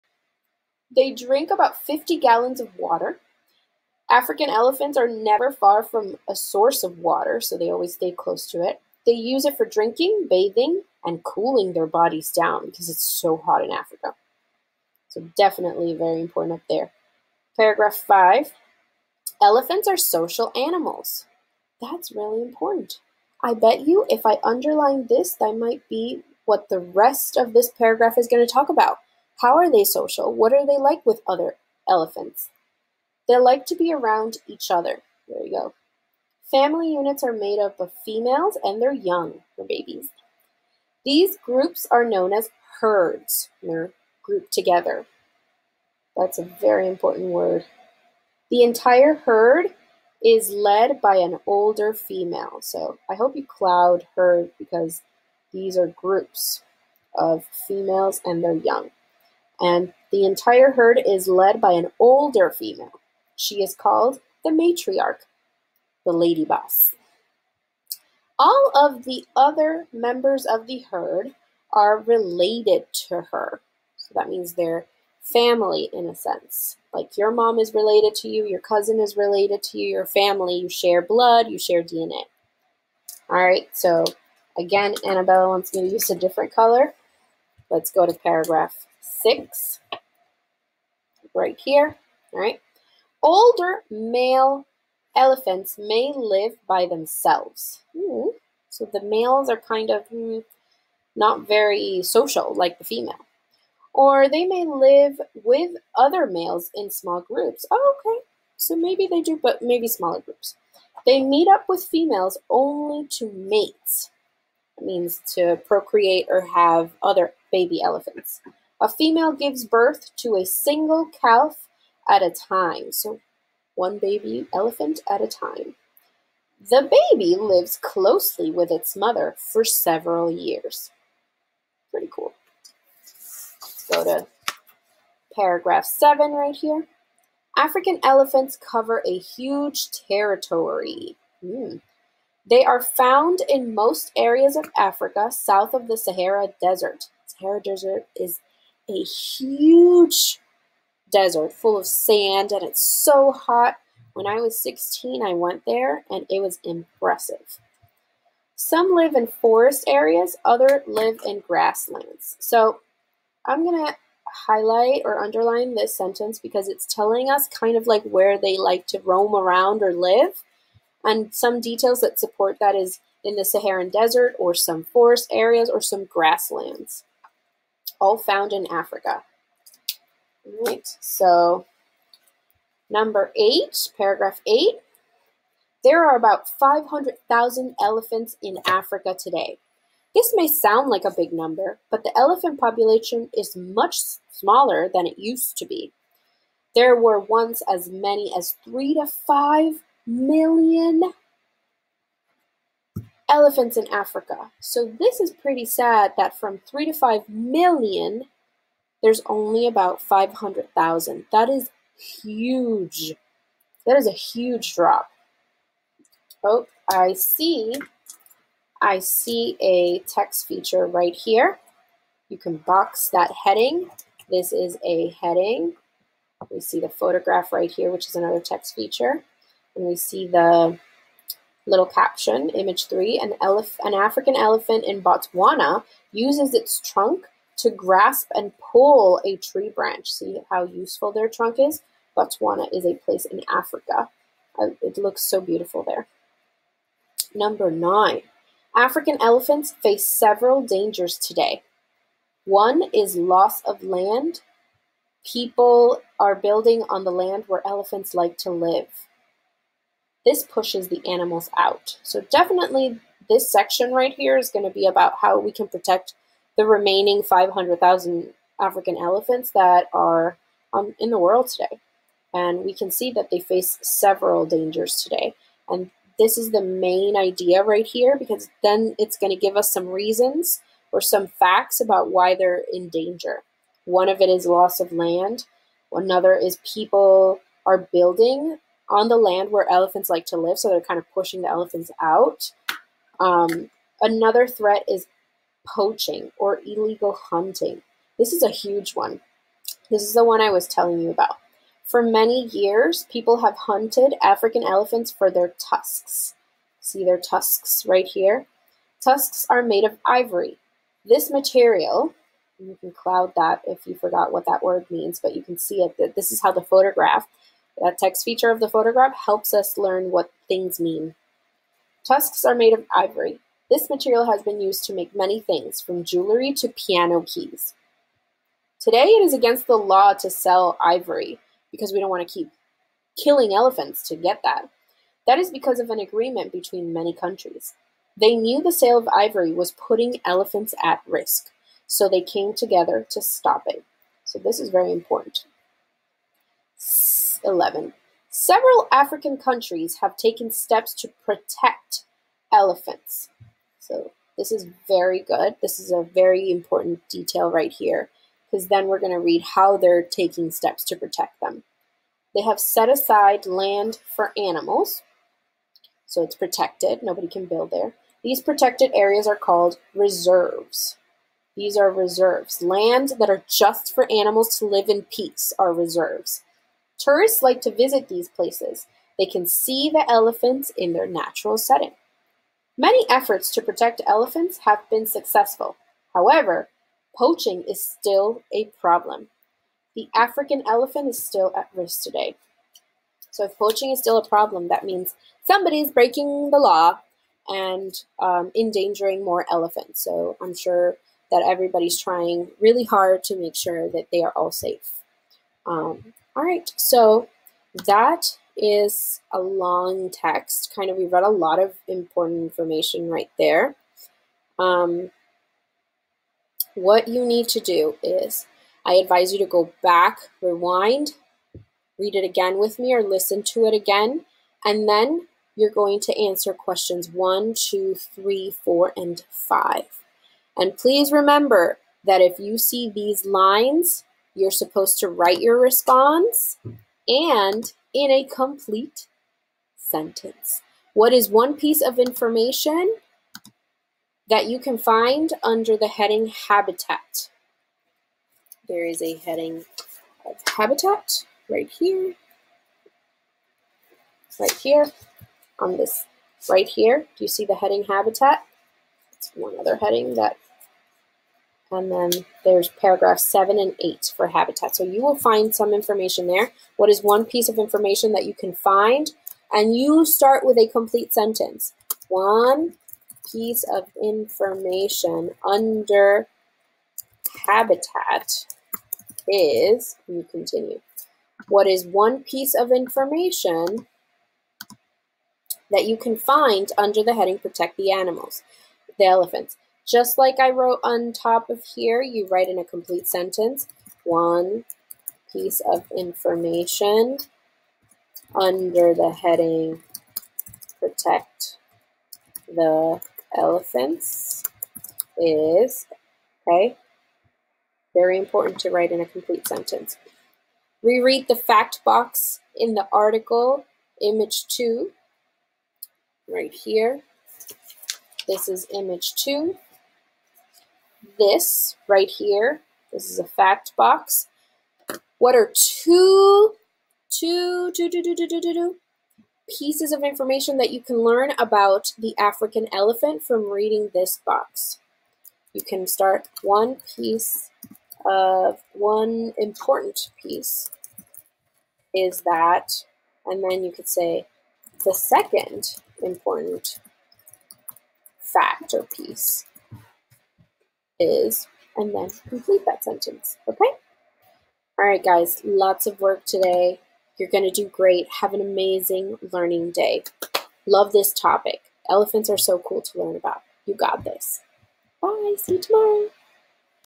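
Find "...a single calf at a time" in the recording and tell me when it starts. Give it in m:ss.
2:00.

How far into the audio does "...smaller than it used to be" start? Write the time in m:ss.
3:14.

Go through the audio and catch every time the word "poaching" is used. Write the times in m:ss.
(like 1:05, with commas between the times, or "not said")
4:55, 6:27, 6:33.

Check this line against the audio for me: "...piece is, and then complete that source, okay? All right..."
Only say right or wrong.
wrong.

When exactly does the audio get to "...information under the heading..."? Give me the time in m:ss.
8:15.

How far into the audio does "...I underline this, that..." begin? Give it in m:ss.
0:24.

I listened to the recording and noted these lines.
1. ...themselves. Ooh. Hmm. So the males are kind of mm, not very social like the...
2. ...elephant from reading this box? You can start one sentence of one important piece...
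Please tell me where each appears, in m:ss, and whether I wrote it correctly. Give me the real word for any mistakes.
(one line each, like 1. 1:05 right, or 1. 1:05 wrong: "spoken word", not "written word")
1. 1:36 right
2. 8:52 wrong: "piece", not "sentence".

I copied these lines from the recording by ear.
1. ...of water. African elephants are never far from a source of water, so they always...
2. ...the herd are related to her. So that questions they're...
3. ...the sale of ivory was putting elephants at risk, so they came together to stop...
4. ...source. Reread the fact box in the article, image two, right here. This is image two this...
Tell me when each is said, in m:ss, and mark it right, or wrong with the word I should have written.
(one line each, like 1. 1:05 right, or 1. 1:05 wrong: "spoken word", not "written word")
1. 0:02 right
2. 1:10 wrong: "means", not "questions"
3. 5:38 right
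4. 8:29 wrong: "sentence", not "source".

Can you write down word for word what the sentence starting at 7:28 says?
There is a heading of habitat right here, right here, on this right here.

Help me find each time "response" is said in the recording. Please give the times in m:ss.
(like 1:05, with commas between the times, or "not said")
7:15.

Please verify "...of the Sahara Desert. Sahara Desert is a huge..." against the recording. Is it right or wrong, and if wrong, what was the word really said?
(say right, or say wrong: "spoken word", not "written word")
right.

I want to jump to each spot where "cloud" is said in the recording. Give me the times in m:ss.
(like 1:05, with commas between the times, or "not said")
0:53, 5:12.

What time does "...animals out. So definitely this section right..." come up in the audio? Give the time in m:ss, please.
4:21.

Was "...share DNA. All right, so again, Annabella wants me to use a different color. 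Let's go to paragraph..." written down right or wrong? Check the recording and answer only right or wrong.
right.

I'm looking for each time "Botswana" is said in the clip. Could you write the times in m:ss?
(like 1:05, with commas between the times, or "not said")
3:55, 4:02.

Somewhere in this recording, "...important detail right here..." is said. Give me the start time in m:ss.
5:56.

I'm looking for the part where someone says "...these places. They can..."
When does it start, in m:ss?
6:18.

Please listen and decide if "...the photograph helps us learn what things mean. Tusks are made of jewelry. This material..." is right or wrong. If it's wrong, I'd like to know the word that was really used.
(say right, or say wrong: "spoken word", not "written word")
wrong: "ivory", not "jewelry".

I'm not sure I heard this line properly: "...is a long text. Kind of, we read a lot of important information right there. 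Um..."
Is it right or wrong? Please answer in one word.
right.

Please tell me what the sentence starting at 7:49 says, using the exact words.
And you start with a complete sentence.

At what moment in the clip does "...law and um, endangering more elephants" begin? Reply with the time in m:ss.
6:36.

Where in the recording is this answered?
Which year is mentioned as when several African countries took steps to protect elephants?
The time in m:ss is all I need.
5:47.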